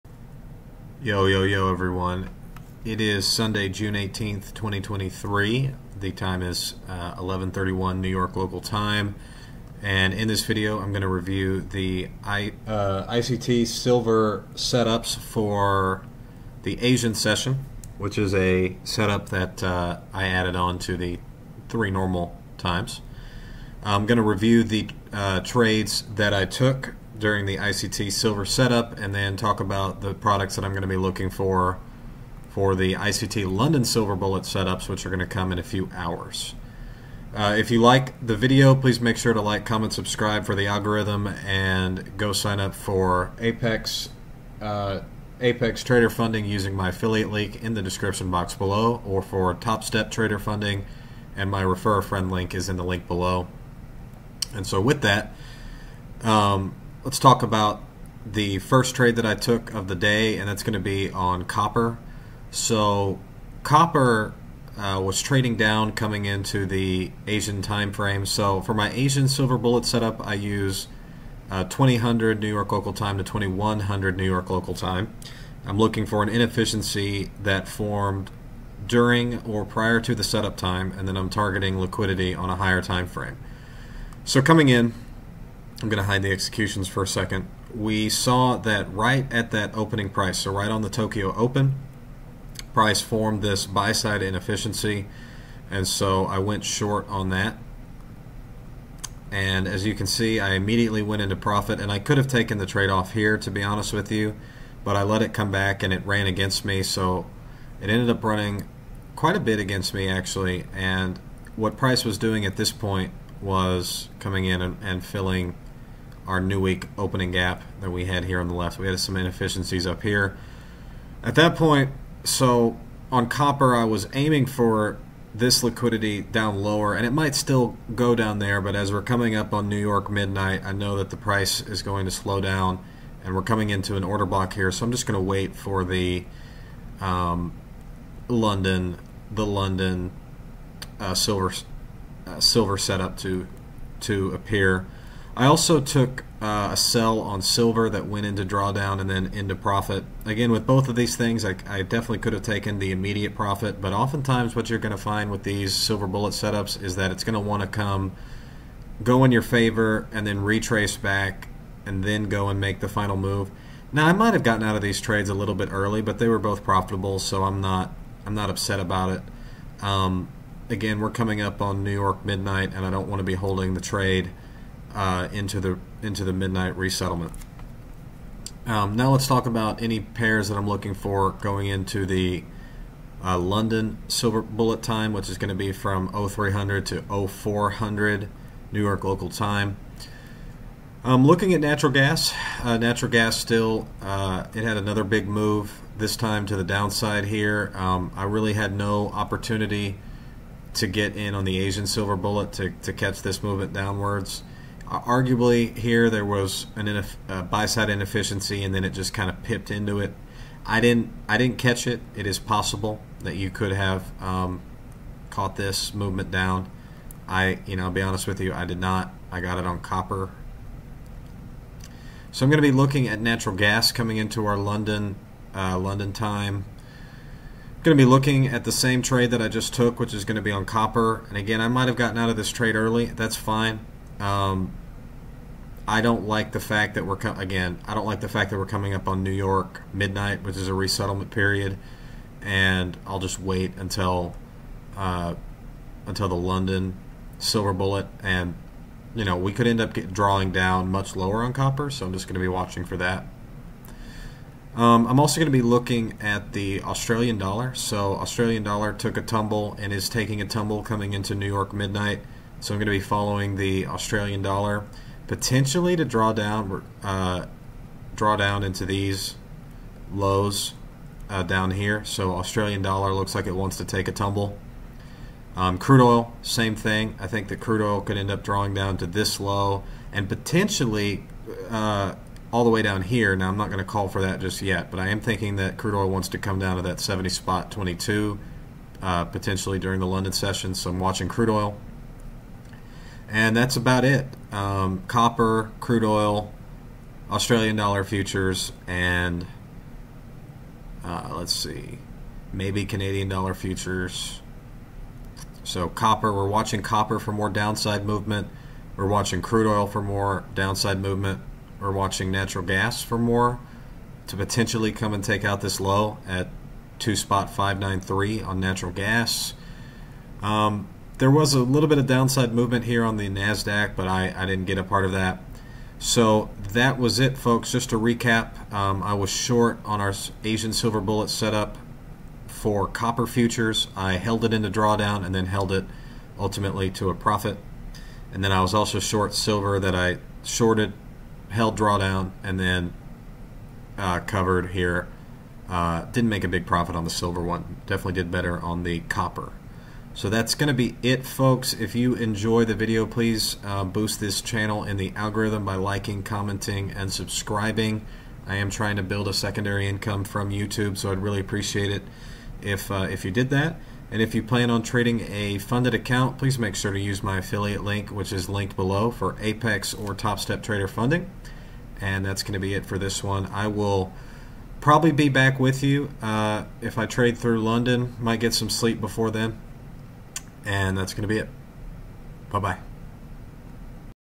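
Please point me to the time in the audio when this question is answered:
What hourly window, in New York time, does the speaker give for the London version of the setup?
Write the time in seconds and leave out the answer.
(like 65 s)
186 s.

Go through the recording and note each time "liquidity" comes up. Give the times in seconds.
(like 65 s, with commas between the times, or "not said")
81 s, 125 s.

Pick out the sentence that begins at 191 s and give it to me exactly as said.
Um, looking at natural gas, uh, natural gas still, uh, it had another big move, this time to the downside here.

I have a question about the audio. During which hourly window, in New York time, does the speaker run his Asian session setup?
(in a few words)
2000 to 2100.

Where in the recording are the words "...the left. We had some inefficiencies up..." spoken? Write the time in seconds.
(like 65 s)
118 s.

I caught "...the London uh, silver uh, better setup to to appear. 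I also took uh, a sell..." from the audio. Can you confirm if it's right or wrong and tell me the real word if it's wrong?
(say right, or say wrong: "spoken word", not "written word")
wrong: "silver", not "better".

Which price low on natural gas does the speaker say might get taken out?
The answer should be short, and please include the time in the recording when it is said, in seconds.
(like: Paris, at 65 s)
2.593, at 316 s.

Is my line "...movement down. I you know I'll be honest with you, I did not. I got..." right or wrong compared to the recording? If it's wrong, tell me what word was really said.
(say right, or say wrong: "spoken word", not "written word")
right.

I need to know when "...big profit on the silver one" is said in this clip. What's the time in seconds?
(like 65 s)
346 s.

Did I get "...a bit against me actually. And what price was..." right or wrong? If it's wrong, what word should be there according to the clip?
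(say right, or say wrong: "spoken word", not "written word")
right.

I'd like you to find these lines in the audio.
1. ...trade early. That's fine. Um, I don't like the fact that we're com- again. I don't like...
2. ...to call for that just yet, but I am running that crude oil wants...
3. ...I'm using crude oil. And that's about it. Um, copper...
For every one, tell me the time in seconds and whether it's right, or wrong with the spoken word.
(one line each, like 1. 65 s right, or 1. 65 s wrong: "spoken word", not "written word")
1. 232 s right
2. 283 s wrong: "thinking", not "running"
3. 290 s wrong: "watching", not "using".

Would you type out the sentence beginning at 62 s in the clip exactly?
So copper uh, was trading down coming into the Asian time frame.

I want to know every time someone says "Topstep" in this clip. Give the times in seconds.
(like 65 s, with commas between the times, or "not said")
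49 s, 370 s.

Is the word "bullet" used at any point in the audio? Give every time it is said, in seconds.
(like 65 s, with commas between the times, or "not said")
34 s, 69 s, 156 s, 184 s, 202 s, 247 s, 330 s.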